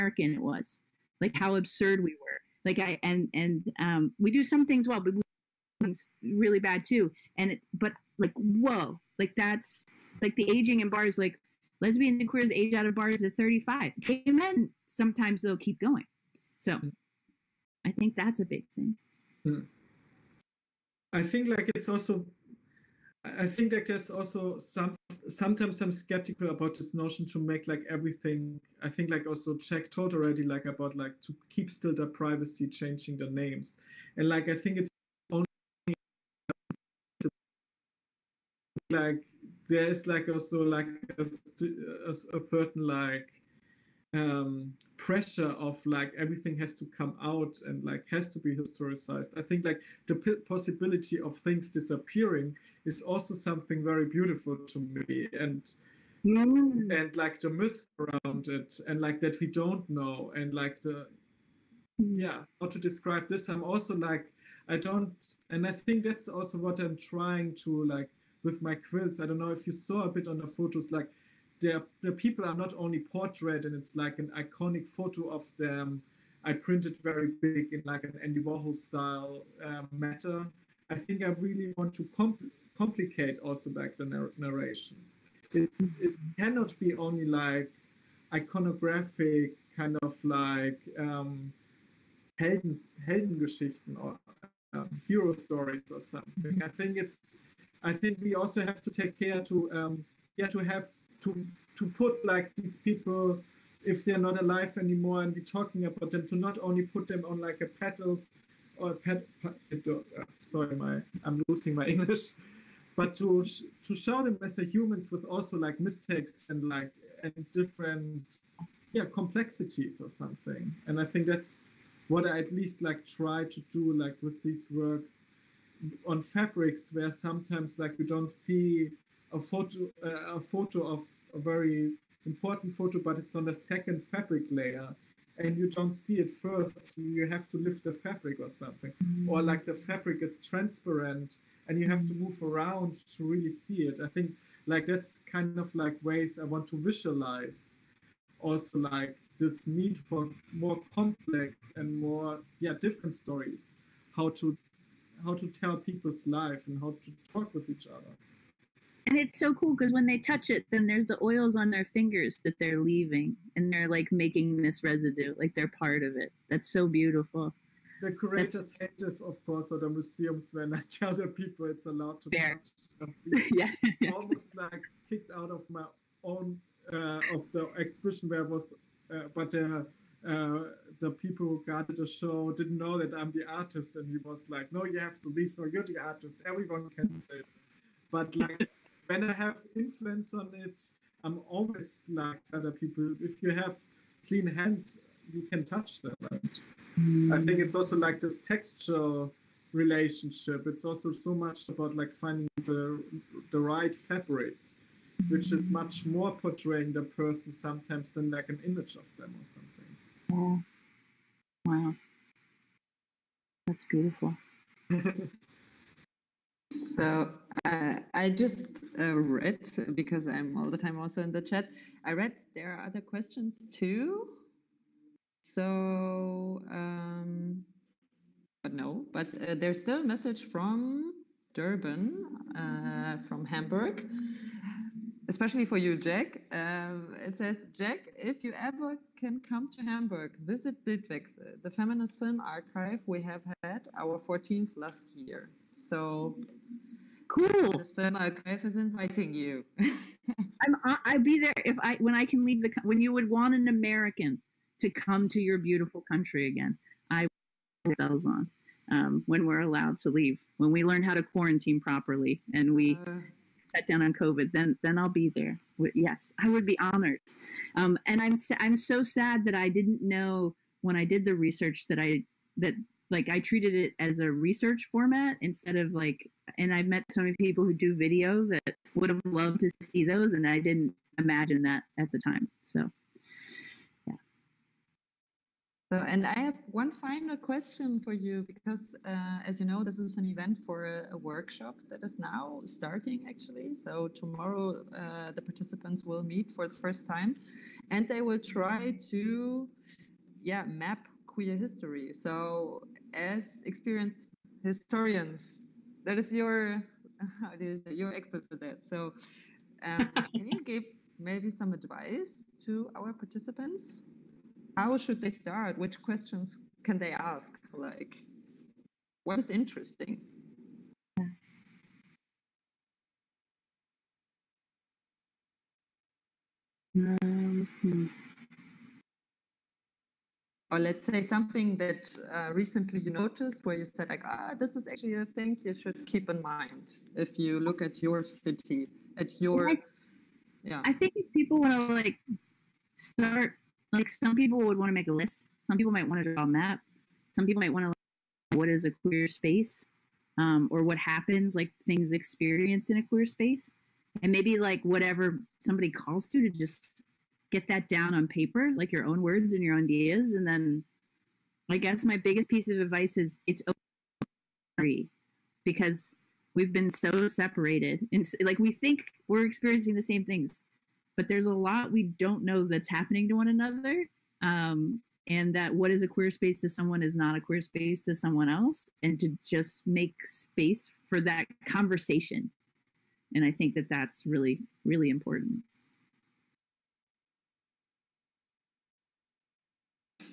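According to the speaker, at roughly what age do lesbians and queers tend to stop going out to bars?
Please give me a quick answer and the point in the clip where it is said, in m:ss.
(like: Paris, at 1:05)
35, at 0:13.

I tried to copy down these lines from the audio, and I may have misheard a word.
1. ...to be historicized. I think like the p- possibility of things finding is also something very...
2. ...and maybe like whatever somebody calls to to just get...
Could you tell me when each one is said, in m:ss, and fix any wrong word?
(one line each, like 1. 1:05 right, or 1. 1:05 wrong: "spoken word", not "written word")
1. 0:48 wrong: "disappearing", not "finding"
2. 5:54 right.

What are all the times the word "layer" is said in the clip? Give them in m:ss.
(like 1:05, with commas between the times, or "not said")
2:14.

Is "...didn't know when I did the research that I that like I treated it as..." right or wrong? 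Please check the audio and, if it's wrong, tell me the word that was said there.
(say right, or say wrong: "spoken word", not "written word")
right.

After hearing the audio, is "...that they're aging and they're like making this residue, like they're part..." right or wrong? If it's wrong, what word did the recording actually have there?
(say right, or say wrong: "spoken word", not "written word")
wrong: "leaving", not "aging".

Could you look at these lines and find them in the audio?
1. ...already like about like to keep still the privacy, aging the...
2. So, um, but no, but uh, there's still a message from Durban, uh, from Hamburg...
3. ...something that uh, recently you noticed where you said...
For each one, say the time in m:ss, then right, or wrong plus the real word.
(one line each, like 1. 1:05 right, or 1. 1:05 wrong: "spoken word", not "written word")
1. 0:30 wrong: "changing", not "aging"
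2. 3:45 right
3. 5:31 right.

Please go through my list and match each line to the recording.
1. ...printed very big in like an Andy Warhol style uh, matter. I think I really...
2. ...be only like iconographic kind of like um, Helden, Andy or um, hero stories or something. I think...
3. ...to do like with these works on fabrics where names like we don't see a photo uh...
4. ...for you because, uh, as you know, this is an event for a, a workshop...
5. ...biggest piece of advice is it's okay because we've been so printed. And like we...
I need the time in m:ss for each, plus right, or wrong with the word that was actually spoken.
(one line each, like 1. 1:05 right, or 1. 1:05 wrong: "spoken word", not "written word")
1. 1:16 right
2. 1:26 wrong: "Heldengeschichten", not "Andy"
3. 2:03 wrong: "sometimes", not "names"
4. 4:47 right
5. 6:02 wrong: "separated", not "printed".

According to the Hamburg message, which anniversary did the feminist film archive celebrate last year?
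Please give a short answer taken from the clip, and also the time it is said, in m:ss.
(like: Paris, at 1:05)
14th, at 4:04.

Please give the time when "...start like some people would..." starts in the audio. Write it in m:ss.
5:42.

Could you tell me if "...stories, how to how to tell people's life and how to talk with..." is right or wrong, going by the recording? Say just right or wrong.
right.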